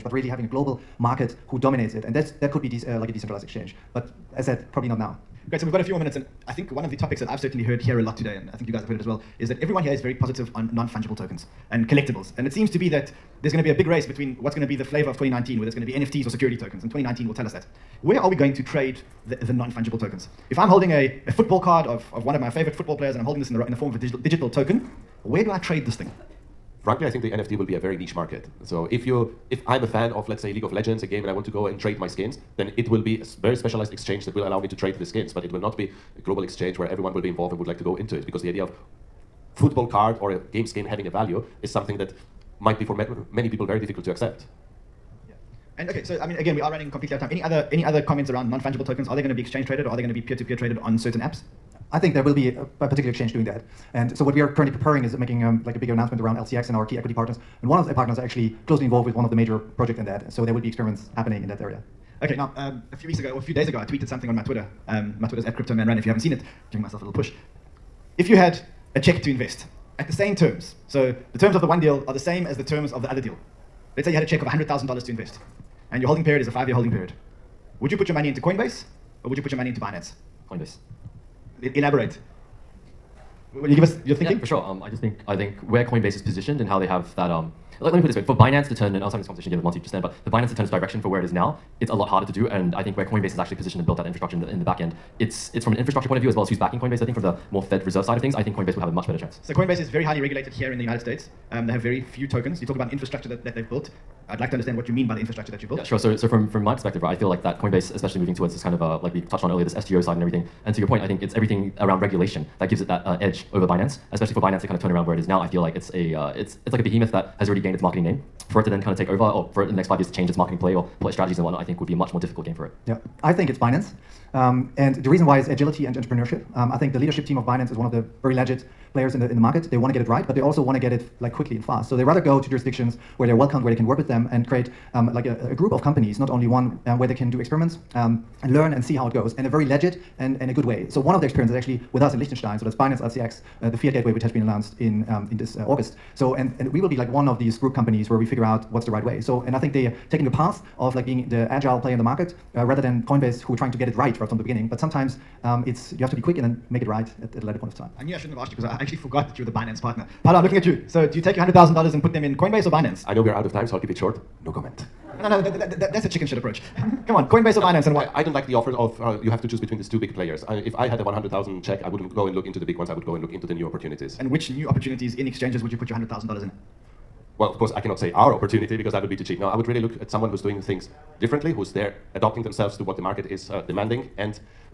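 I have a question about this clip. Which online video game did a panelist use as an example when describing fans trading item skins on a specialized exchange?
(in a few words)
League of Legends.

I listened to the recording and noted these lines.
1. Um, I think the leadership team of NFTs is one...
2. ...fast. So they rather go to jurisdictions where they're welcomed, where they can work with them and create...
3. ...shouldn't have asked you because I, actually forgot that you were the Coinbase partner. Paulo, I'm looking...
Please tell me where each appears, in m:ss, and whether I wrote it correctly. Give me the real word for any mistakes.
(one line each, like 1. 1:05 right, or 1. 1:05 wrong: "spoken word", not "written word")
1. 2:06 wrong: "Binance", not "NFTs"
2. 2:11 right
3. 2:38 wrong: "Binance", not "Coinbase".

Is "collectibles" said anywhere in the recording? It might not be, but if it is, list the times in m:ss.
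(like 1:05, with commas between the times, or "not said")
0:11.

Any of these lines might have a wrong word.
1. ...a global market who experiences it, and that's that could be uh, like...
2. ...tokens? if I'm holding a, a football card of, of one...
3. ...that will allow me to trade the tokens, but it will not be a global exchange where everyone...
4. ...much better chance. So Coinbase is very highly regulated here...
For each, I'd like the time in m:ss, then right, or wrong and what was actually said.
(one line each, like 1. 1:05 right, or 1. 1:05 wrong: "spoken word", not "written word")
1. 0:00 wrong: "dominates", not "experiences"
2. 0:19 right
3. 0:34 wrong: "skins", not "tokens"
4. 1:38 right.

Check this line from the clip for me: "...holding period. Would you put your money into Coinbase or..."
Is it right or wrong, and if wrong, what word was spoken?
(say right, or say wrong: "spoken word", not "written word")
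right.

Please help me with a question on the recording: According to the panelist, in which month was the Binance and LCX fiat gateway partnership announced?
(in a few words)
August.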